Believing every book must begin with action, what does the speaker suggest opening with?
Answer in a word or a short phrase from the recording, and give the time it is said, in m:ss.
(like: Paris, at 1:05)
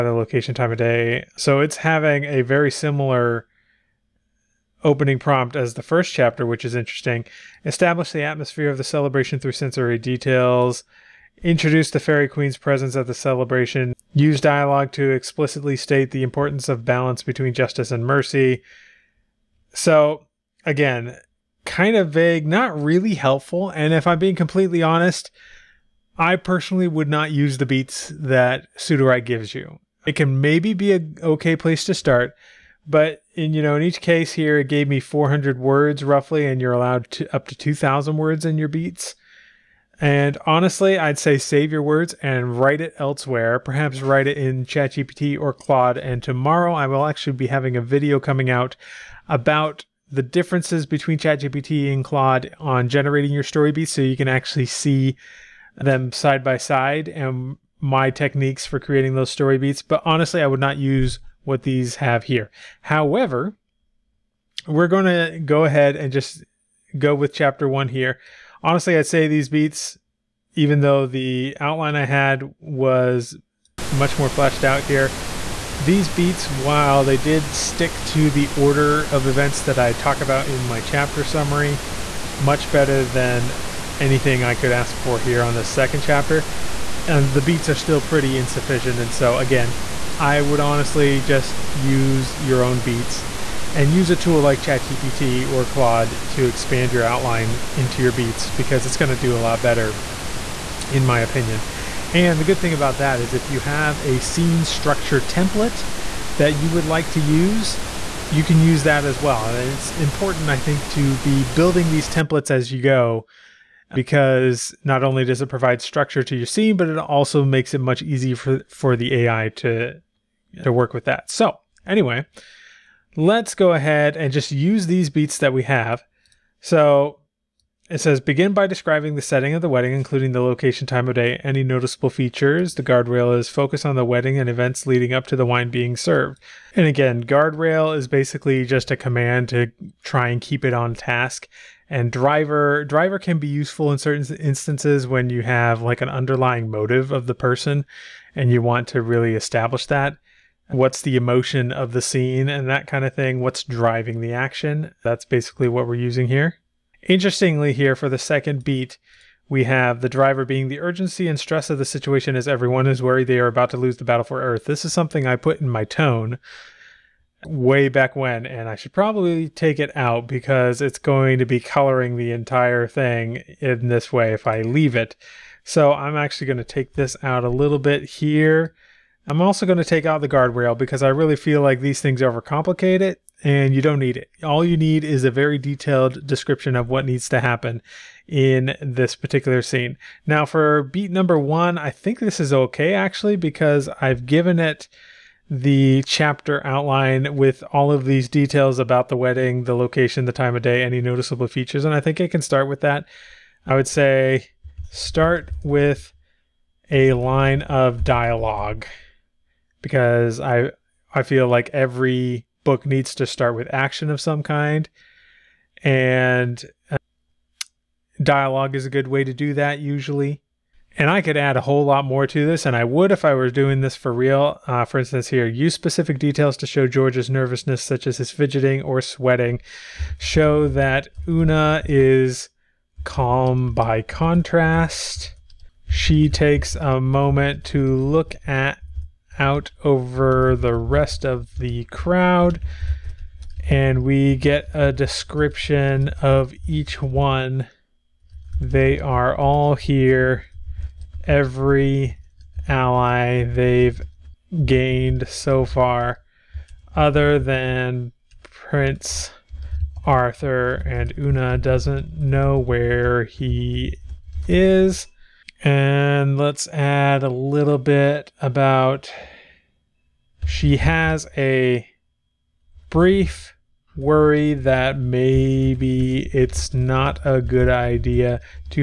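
A line of dialogue, at 3:26.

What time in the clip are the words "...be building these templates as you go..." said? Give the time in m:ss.
1:51.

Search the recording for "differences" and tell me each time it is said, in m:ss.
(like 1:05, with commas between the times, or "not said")
0:50.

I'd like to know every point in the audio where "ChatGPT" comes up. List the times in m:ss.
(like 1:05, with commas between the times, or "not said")
0:44, 0:51, 1:34.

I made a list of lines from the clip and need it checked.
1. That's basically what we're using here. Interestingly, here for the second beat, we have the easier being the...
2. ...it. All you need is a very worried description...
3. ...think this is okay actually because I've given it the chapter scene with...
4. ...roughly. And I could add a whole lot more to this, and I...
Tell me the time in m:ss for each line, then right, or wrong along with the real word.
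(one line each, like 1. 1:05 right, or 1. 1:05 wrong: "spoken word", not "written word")
1. 2:35 wrong: "driver", not "easier"
2. 3:04 wrong: "detailed", not "worried"
3. 3:11 wrong: "outline", not "scene"
4. 3:39 wrong: "usually", not "roughly".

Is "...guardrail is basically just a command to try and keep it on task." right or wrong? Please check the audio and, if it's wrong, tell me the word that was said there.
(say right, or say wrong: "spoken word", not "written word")
right.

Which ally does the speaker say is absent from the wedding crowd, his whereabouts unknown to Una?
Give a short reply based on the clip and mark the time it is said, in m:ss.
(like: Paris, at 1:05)
Prince Arthur, at 4:18.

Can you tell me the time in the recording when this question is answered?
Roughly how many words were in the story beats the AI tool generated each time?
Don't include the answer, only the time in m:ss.
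0:34.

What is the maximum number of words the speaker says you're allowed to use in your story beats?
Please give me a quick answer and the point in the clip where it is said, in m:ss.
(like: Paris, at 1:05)
2,000, at 0:37.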